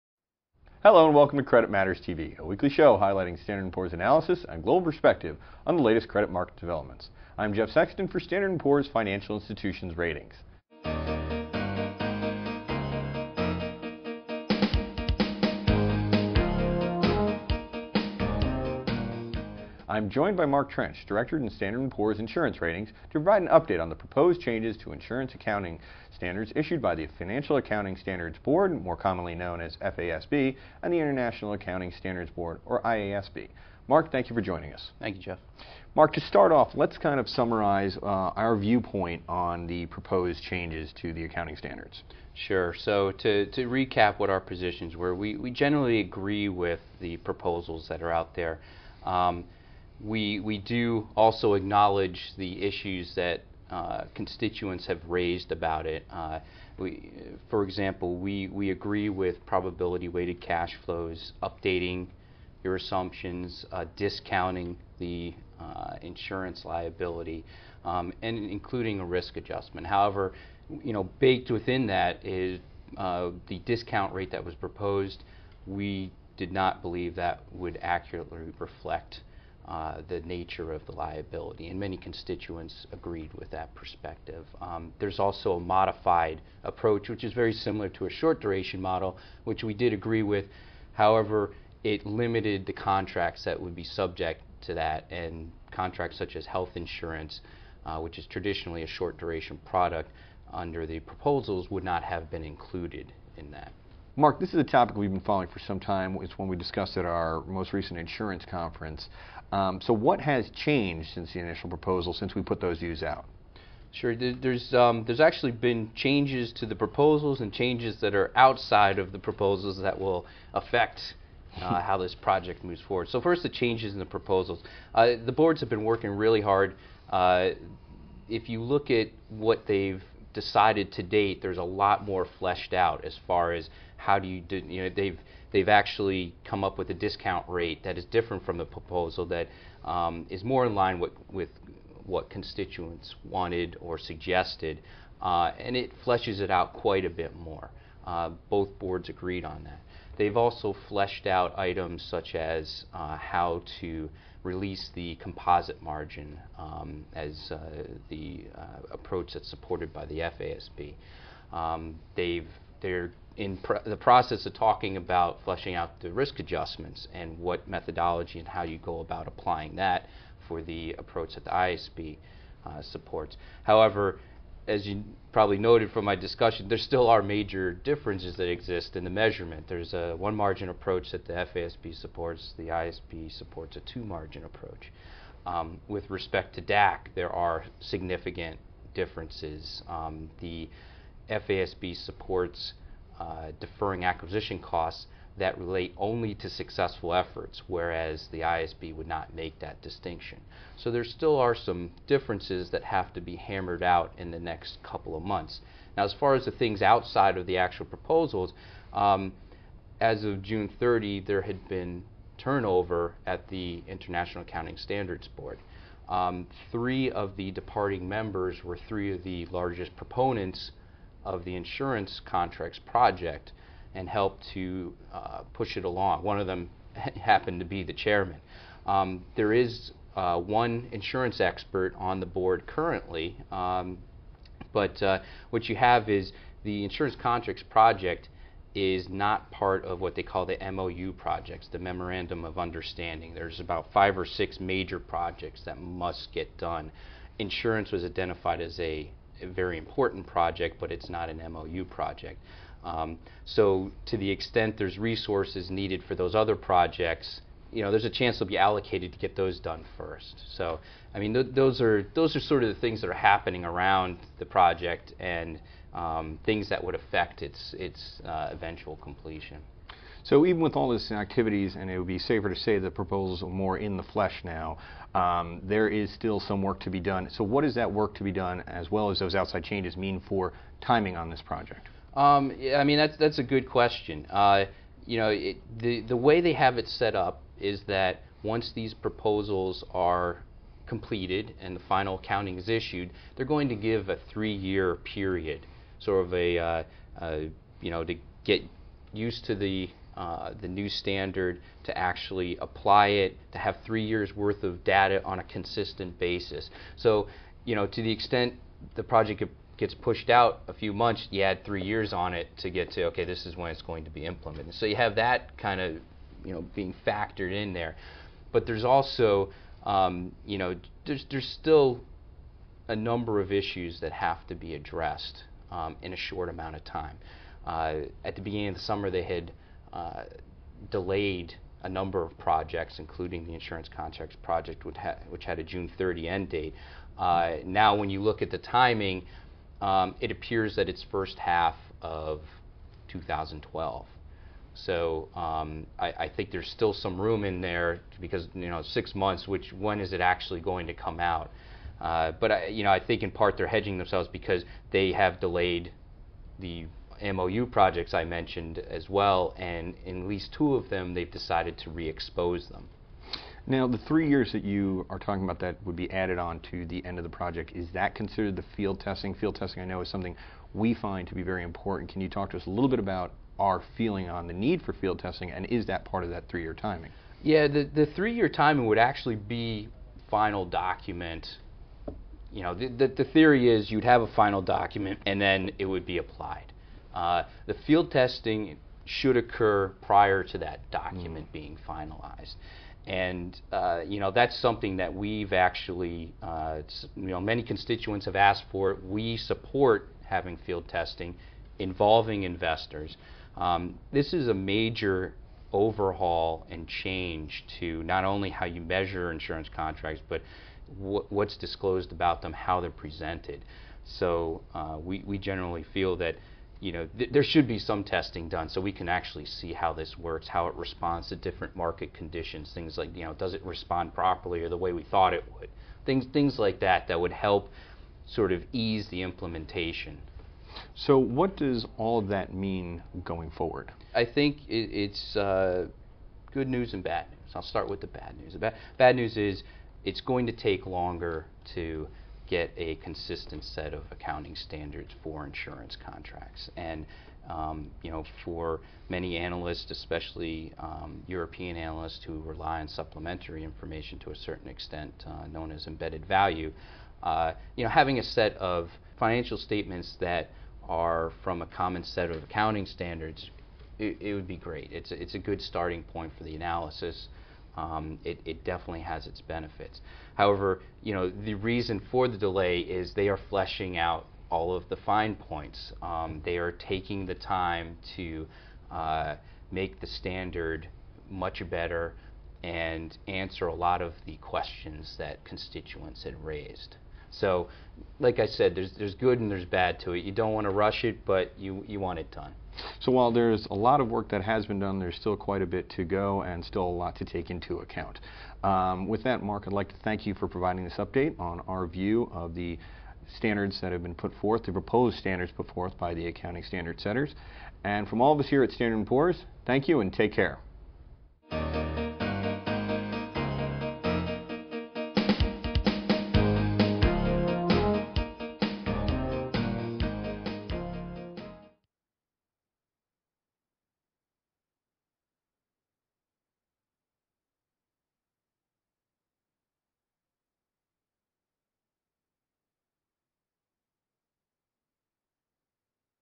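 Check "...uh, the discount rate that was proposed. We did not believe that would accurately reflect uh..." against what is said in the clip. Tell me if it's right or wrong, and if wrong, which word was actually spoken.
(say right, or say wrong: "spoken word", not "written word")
right.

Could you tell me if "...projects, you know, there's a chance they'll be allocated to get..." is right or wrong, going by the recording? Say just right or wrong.
right.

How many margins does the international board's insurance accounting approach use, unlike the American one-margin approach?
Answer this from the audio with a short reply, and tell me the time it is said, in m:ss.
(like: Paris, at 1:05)
2, at 3:03.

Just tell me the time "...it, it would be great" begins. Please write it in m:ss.
7:43.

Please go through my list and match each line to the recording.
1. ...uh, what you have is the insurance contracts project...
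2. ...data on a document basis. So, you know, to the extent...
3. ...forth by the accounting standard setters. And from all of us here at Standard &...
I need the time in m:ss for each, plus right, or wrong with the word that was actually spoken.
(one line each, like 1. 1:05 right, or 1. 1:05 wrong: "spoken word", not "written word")
1. 3:55 right
2. 5:04 wrong: "consistent", not "document"
3. 8:25 right.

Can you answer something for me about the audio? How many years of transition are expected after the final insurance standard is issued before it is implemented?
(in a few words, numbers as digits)
3.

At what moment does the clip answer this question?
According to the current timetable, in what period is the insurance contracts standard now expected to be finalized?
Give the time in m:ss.
5:41.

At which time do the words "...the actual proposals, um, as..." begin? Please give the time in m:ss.
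3:27.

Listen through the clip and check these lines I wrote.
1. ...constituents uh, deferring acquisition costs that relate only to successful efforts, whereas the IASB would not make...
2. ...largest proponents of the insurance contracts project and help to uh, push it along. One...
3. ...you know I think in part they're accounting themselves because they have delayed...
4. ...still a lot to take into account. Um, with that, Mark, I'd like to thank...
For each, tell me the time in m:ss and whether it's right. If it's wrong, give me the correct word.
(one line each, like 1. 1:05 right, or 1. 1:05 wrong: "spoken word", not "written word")
1. 3:12 wrong: "supports", not "constituents"
2. 3:39 right
3. 5:52 wrong: "hedging", not "accounting"
4. 8:16 right.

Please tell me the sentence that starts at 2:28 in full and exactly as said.
Uh, both boards agreed on that.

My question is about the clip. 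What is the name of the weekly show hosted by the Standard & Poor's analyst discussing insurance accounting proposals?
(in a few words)
Credit Matters TV.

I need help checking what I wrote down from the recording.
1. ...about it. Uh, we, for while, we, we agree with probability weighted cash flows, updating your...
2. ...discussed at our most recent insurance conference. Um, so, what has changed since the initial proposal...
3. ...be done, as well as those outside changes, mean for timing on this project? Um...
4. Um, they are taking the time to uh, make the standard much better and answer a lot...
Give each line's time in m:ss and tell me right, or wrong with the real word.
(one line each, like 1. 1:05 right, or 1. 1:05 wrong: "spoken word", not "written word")
1. 0:55 wrong: "example", not "while"
2. 1:46 right
3. 4:38 right
4. 7:56 right.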